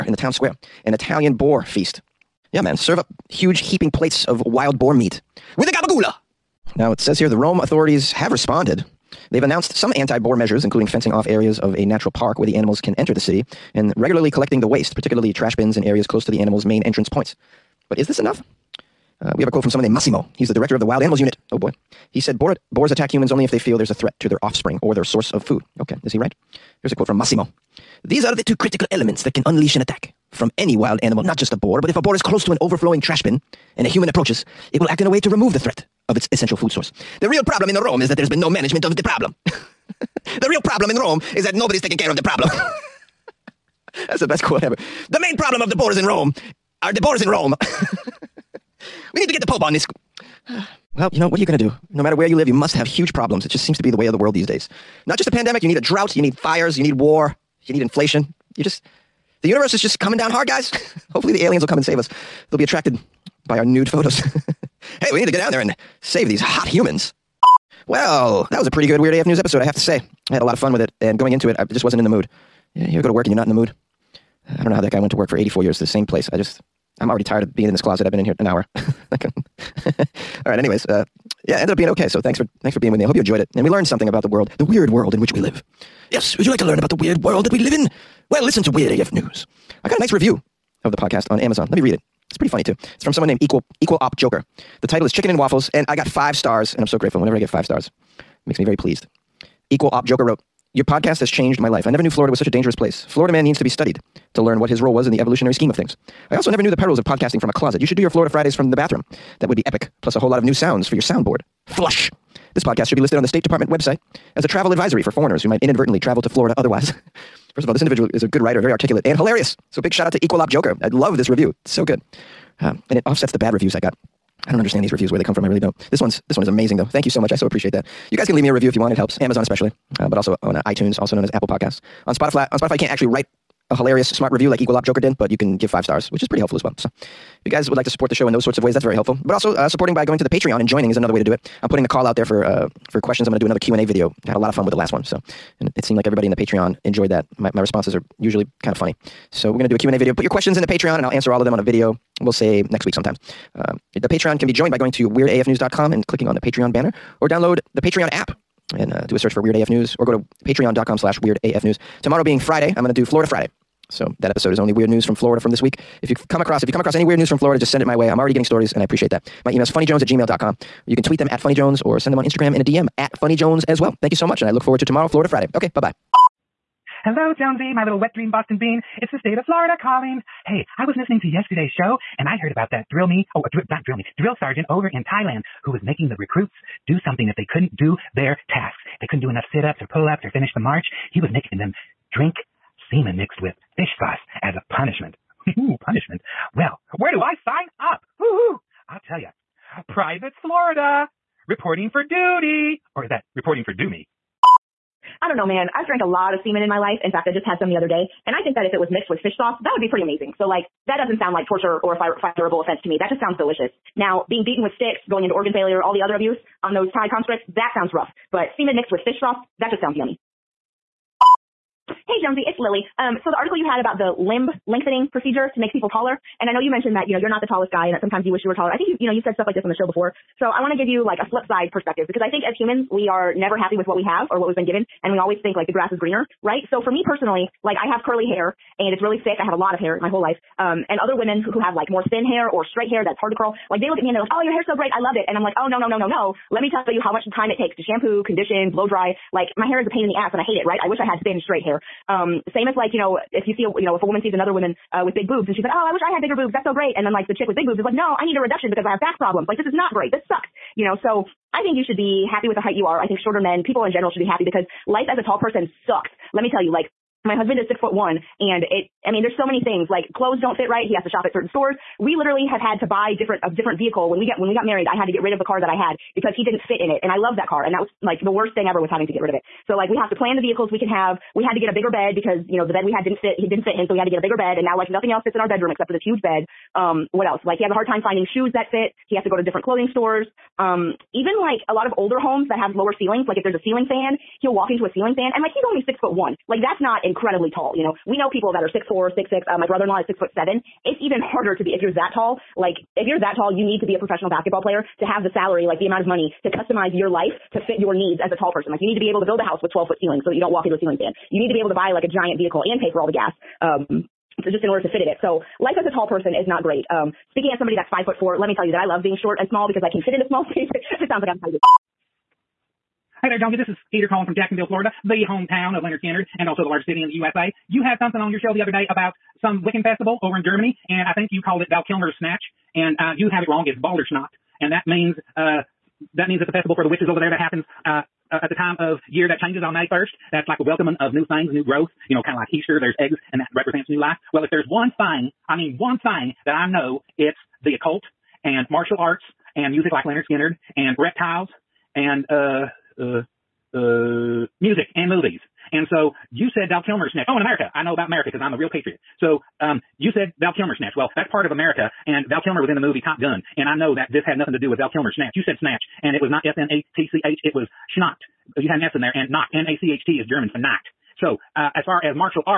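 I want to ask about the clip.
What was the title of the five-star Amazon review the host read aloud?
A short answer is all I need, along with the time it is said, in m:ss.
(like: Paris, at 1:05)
Chicken and Waffles, at 1:35.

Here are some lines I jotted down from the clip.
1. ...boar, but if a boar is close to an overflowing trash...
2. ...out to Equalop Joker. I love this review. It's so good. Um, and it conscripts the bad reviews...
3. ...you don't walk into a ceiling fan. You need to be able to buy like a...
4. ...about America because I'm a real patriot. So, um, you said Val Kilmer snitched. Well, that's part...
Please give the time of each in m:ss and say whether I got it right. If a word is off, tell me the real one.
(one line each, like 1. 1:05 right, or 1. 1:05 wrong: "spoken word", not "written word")
1. 0:31 right
2. 2:00 wrong: "offsets", not "conscripts"
3. 5:10 right
4. 5:57 right.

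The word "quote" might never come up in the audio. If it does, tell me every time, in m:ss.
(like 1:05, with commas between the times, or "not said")
0:19, 0:26, 0:44.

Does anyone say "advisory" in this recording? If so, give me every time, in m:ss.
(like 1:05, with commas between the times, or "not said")
1:54.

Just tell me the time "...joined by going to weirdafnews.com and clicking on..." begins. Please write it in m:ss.
2:34.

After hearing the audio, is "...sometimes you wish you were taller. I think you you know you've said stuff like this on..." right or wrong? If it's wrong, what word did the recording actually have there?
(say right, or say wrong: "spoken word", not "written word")
right.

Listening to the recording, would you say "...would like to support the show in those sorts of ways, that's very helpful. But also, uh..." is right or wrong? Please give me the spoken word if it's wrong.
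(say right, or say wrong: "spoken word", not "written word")
right.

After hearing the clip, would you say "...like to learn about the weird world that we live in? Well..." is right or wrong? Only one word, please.
right.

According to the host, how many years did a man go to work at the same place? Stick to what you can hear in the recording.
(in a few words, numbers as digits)
84.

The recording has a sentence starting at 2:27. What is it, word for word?
My my responses are usually kind of funny.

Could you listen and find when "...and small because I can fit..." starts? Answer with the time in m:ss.
5:19.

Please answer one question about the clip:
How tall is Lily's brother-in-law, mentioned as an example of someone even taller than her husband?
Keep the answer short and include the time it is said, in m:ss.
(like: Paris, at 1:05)
6 foot 7, at 5:00.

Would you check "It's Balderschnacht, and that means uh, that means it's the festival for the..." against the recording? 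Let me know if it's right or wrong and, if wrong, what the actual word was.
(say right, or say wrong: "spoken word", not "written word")
right.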